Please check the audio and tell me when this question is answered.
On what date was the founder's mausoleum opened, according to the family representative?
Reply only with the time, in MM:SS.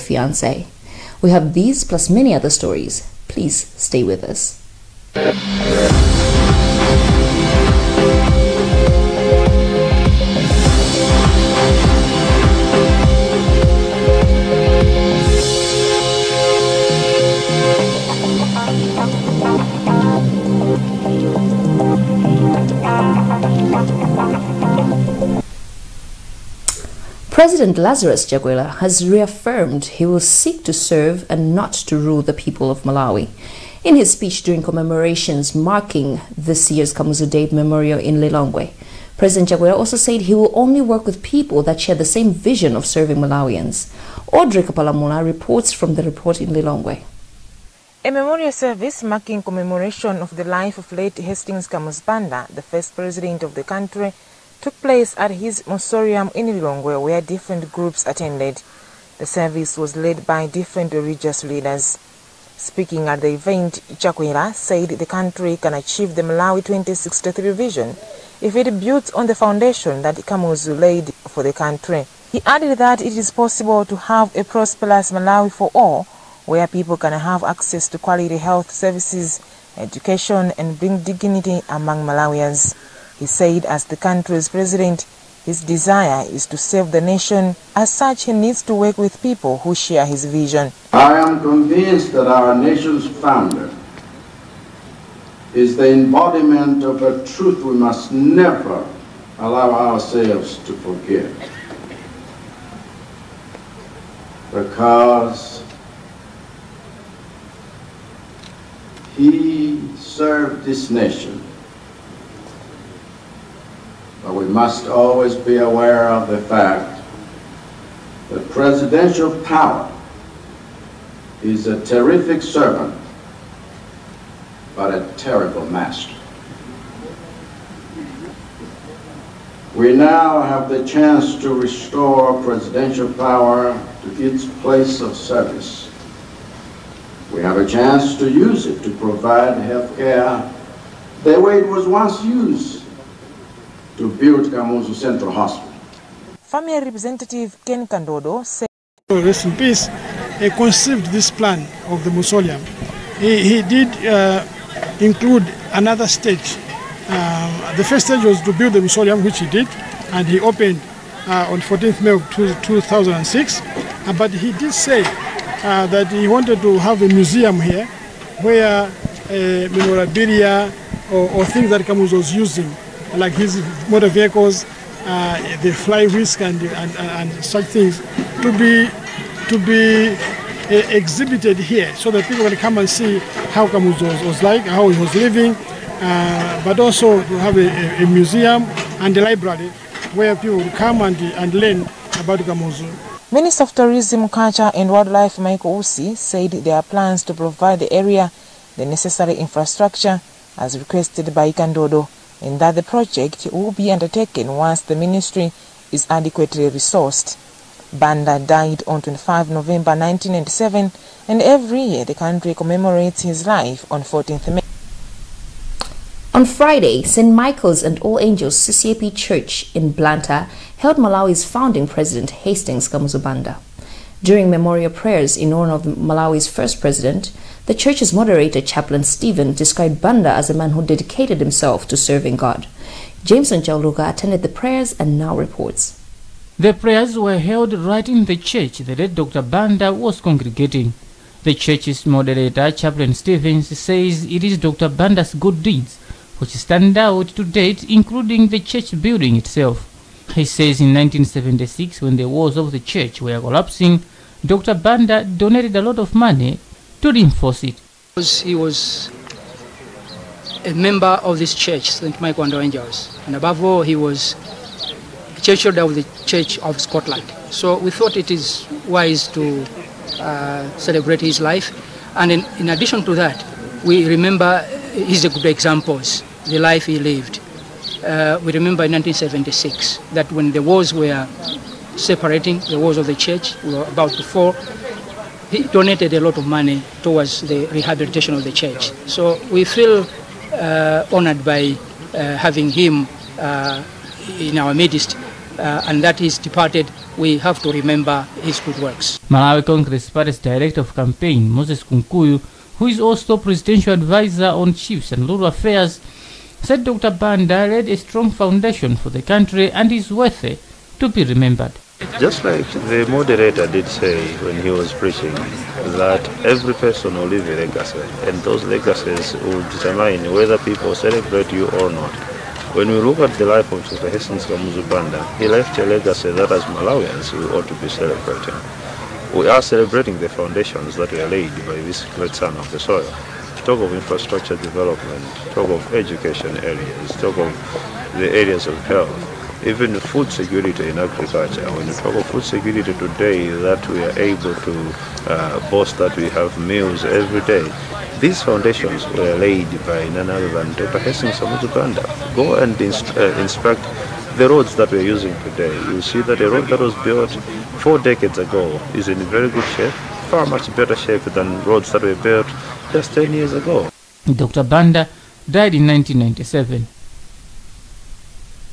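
02:41.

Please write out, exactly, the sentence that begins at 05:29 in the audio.
We are celebrating the foundations that were laid by this great son of the soil.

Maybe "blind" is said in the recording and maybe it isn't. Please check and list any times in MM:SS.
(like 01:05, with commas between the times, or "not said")
not said.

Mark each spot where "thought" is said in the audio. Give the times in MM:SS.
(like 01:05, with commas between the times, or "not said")
04:27.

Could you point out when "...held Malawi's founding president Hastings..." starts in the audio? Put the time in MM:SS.
03:40.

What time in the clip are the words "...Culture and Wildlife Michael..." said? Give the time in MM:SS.
03:14.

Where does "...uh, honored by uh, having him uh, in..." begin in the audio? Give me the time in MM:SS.
04:50.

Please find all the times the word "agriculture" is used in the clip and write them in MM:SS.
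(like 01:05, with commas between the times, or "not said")
05:40.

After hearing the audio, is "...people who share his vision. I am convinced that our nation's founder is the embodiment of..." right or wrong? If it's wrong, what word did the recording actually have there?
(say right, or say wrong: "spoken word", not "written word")
right.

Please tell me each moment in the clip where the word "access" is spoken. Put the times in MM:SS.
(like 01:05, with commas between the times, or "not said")
01:17.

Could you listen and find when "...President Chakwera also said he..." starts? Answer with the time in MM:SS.
00:39.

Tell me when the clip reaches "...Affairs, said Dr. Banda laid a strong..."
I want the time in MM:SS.
05:05.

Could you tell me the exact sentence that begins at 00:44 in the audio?
Audrey Kapalamuna reports from the report in Lilongwe.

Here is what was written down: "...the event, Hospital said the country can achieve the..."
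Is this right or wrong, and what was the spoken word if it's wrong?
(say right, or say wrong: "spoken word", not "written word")
wrong: "Chakwera", not "Hospital".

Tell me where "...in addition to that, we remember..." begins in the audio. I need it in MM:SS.
04:32.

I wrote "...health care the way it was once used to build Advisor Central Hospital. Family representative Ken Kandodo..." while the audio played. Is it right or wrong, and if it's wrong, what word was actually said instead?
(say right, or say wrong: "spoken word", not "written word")
wrong: "Kamuzu", not "Advisor".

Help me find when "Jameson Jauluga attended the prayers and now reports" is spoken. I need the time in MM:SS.
03:53.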